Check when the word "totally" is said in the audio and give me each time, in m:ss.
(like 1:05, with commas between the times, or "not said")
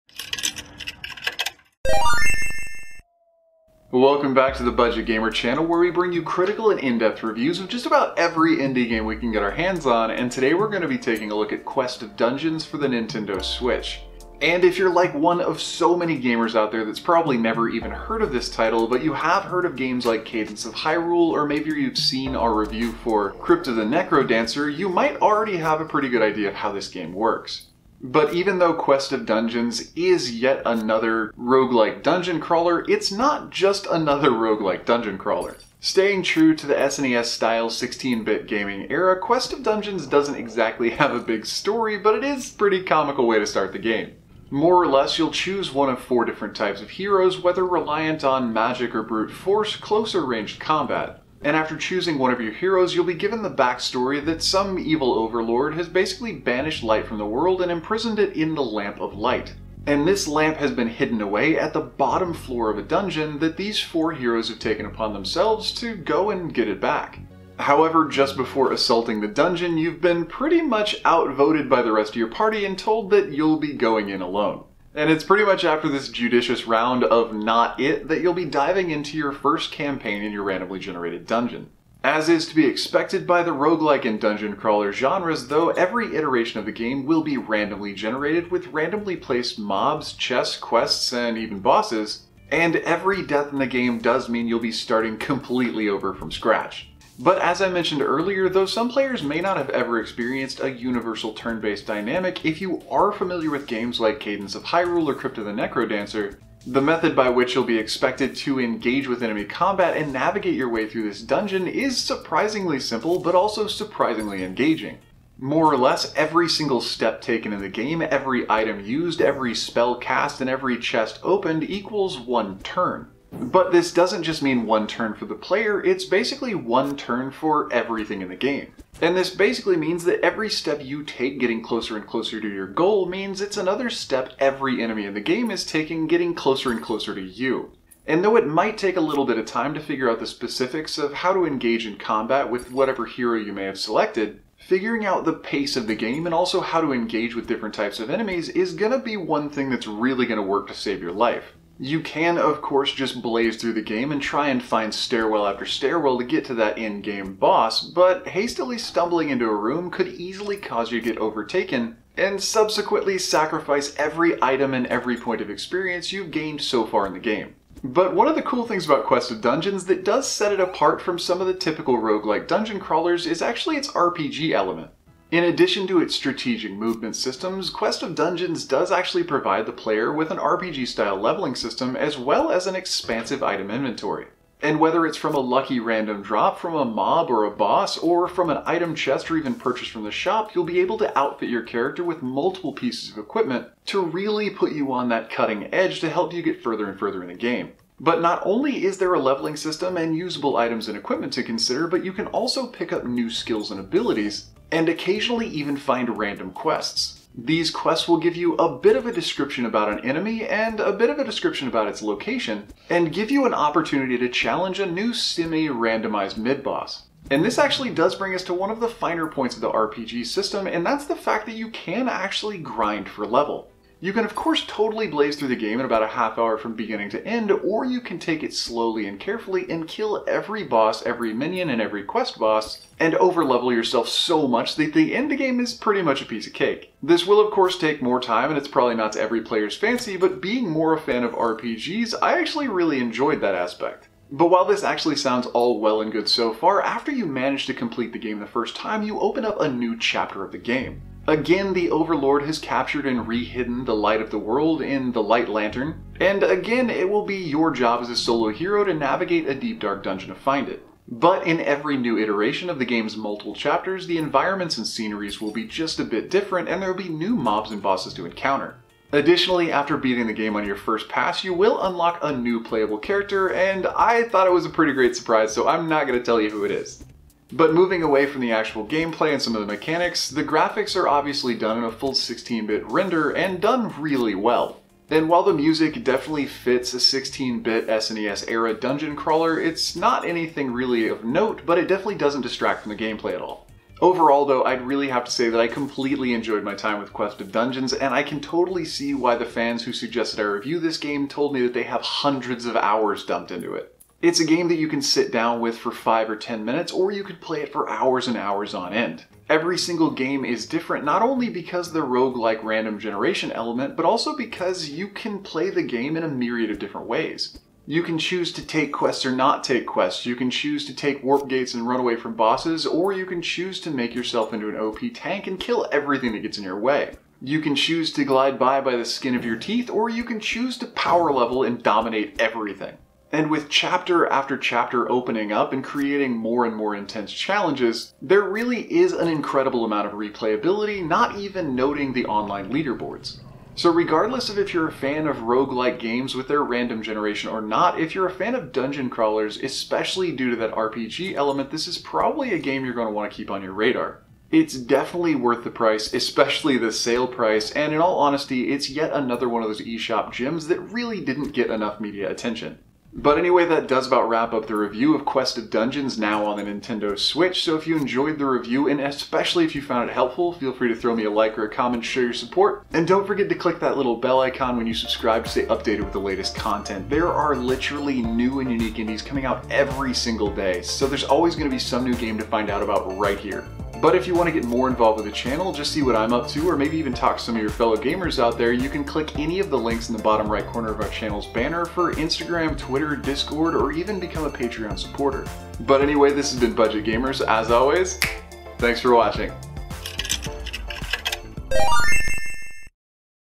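3:44, 4:58.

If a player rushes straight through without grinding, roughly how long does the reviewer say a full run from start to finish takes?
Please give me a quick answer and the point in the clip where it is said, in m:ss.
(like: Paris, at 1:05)
About a half hour, at 3:45.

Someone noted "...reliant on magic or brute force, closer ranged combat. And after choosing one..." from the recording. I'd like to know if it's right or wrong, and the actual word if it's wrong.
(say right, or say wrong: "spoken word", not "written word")
right.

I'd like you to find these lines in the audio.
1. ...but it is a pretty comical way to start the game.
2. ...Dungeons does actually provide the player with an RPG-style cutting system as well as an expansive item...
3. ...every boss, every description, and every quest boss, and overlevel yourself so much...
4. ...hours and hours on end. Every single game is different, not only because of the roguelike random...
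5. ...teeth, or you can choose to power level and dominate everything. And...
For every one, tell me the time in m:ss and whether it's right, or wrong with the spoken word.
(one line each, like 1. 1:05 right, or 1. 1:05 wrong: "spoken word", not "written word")
1. 0:41 right
2. 2:58 wrong: "leveling", not "cutting"
3. 3:50 wrong: "minion", not "description"
4. 5:07 right
5. 5:29 right.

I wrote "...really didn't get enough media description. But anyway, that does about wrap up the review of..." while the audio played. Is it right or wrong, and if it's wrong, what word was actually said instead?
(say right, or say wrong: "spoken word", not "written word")
wrong: "attention", not "description".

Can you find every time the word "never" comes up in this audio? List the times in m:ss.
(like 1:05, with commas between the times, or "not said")
0:17.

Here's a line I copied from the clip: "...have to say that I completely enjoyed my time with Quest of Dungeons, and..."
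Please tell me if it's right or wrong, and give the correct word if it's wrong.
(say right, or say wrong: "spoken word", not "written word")
right.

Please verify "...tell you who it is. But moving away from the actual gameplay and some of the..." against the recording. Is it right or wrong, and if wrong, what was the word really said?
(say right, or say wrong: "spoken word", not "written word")
right.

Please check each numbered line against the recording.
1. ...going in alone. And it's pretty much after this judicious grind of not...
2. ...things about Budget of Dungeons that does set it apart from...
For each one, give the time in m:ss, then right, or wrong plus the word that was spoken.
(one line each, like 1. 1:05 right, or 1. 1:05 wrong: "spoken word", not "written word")
1. 1:13 wrong: "round", not "grind"
2. 2:48 wrong: "Quest", not "Budget".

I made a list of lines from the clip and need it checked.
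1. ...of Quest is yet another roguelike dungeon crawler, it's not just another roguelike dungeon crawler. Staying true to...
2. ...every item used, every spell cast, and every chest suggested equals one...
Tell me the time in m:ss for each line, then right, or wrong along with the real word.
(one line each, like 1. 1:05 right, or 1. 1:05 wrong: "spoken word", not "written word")
1. 0:29 wrong: "Dungeons", not "Quest"
2. 1:58 wrong: "opened", not "suggested".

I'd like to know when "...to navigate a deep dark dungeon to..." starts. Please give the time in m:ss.
4:18.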